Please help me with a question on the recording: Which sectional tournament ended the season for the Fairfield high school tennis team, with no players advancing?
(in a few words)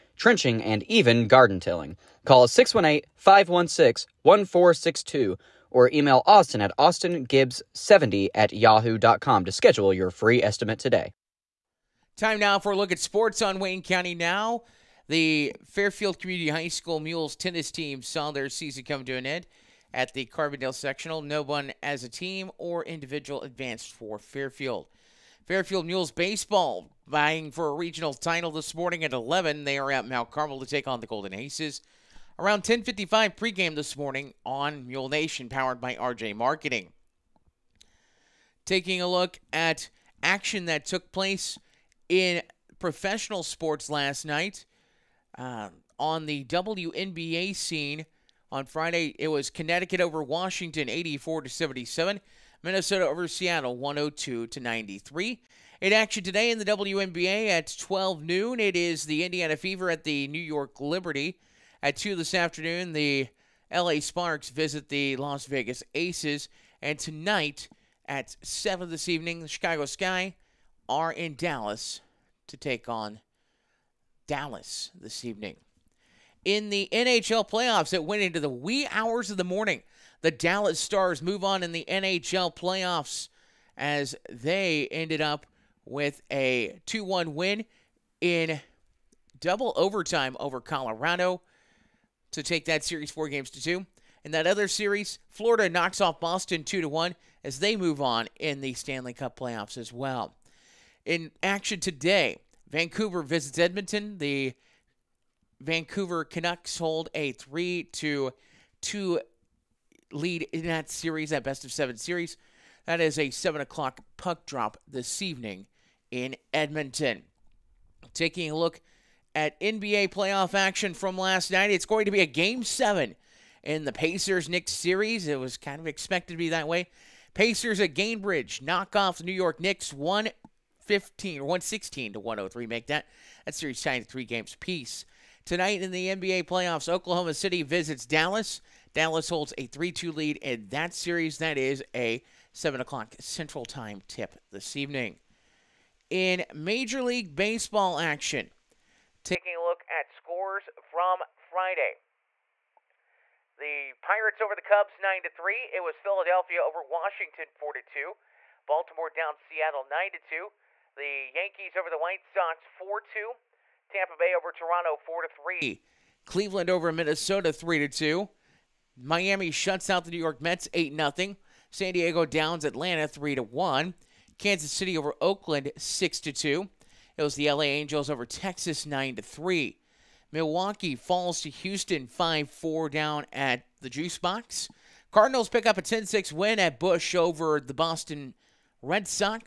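Carbondale.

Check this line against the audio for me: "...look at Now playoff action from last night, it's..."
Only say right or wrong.
wrong.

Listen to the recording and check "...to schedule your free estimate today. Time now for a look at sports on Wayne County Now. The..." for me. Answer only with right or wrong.
right.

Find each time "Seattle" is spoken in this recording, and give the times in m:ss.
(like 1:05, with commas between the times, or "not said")
0:53, 2:39.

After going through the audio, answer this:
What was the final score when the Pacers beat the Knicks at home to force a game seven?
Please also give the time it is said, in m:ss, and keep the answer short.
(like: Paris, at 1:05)
116 to 103, at 2:11.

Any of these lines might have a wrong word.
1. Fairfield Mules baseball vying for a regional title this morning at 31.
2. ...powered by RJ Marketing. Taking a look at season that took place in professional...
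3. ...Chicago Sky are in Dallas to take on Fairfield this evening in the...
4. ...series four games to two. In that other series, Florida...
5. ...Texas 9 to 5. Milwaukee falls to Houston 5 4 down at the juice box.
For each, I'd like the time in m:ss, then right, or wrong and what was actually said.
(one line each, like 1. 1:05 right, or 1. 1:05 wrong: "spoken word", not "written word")
1. 0:25 wrong: "11", not "31"
2. 0:35 wrong: "action", not "season"
3. 1:09 wrong: "Dallas", not "Fairfield"
4. 1:32 right
5. 2:58 wrong: "3", not "5".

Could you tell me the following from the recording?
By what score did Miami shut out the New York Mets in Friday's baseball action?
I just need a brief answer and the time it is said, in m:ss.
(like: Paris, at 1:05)
8-0, at 2:50.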